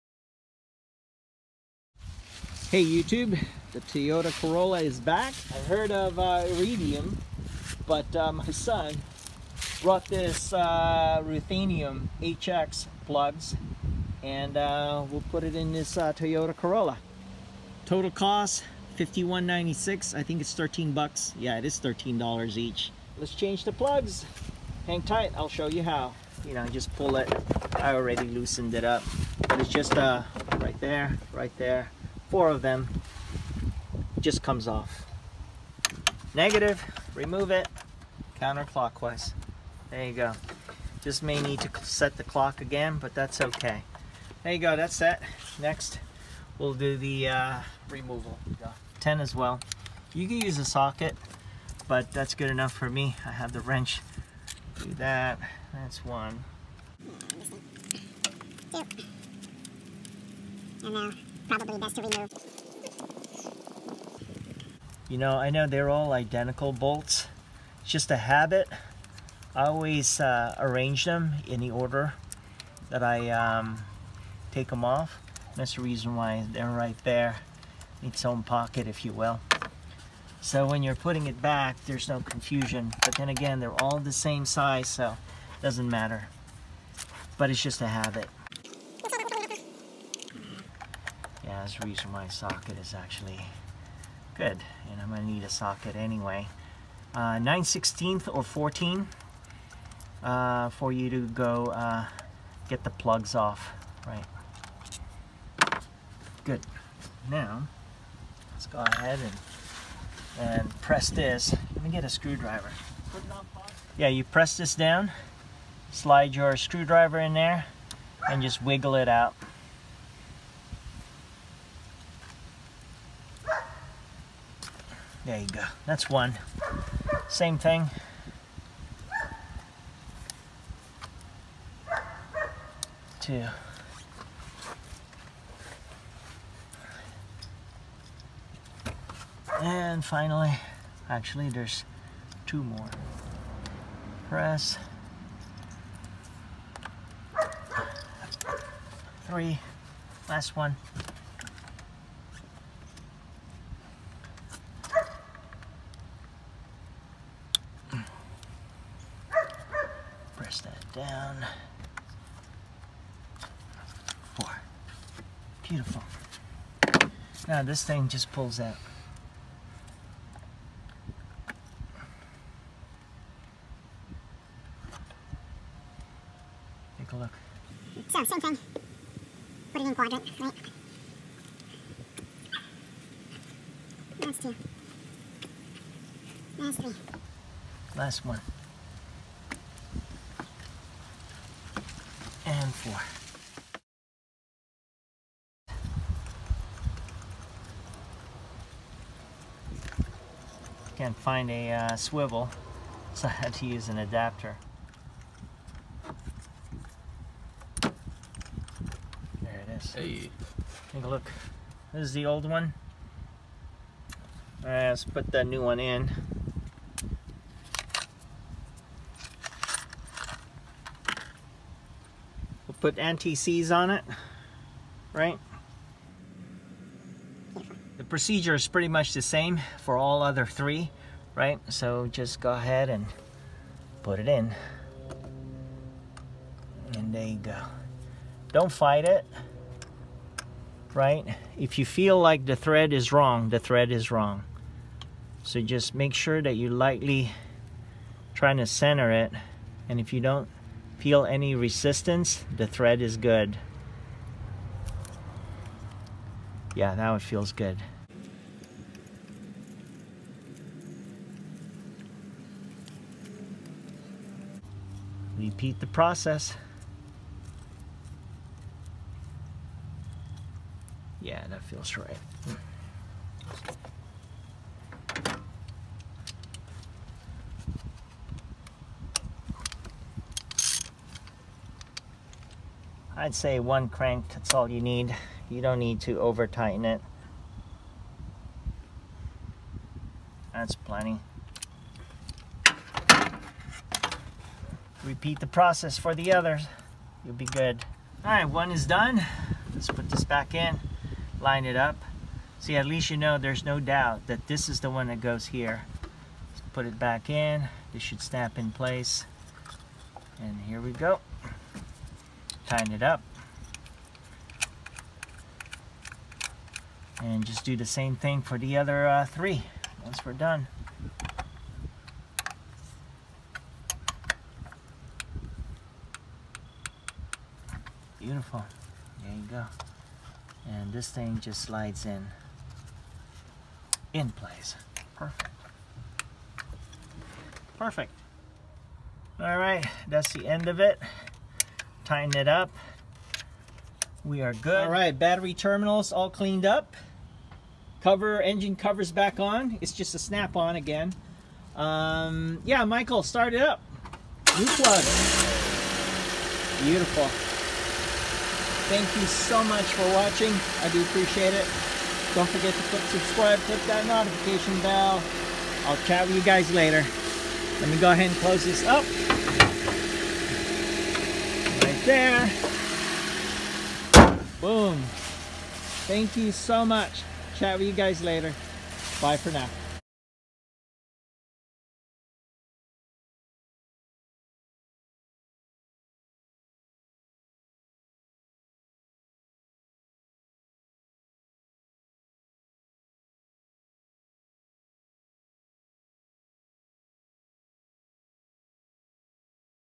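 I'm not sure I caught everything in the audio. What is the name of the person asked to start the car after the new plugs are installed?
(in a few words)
Michael.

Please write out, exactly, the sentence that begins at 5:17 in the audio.
And just do the same thing for the other uh, three once we're done.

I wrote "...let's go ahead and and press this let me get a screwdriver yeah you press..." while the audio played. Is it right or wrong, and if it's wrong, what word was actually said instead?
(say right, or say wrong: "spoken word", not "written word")
right.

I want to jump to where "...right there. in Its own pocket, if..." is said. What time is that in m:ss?
1:16.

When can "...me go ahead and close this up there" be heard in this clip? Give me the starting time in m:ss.
6:07.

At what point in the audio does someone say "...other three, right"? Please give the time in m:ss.
3:50.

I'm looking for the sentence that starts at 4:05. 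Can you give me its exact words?
So just make sure that you're lightly trying to center it.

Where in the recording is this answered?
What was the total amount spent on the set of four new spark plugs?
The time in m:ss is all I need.
0:18.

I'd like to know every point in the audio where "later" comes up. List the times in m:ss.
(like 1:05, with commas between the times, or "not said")
6:06, 6:18.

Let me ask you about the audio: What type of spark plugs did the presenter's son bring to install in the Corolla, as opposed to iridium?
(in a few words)
Ruthenium HX.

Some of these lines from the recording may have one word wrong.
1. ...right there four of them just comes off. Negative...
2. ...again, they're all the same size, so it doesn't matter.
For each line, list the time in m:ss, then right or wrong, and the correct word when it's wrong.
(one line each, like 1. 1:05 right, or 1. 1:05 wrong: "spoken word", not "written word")
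1. 0:31 right
2. 1:23 right.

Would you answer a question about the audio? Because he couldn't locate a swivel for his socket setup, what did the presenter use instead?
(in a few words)
An adapter.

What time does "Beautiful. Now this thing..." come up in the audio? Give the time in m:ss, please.
2:45.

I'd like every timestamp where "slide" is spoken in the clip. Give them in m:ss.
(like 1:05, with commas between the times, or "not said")
1:55, 5:31.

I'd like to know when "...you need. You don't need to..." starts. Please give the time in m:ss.
4:44.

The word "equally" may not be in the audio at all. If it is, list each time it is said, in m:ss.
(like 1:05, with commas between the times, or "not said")
not said.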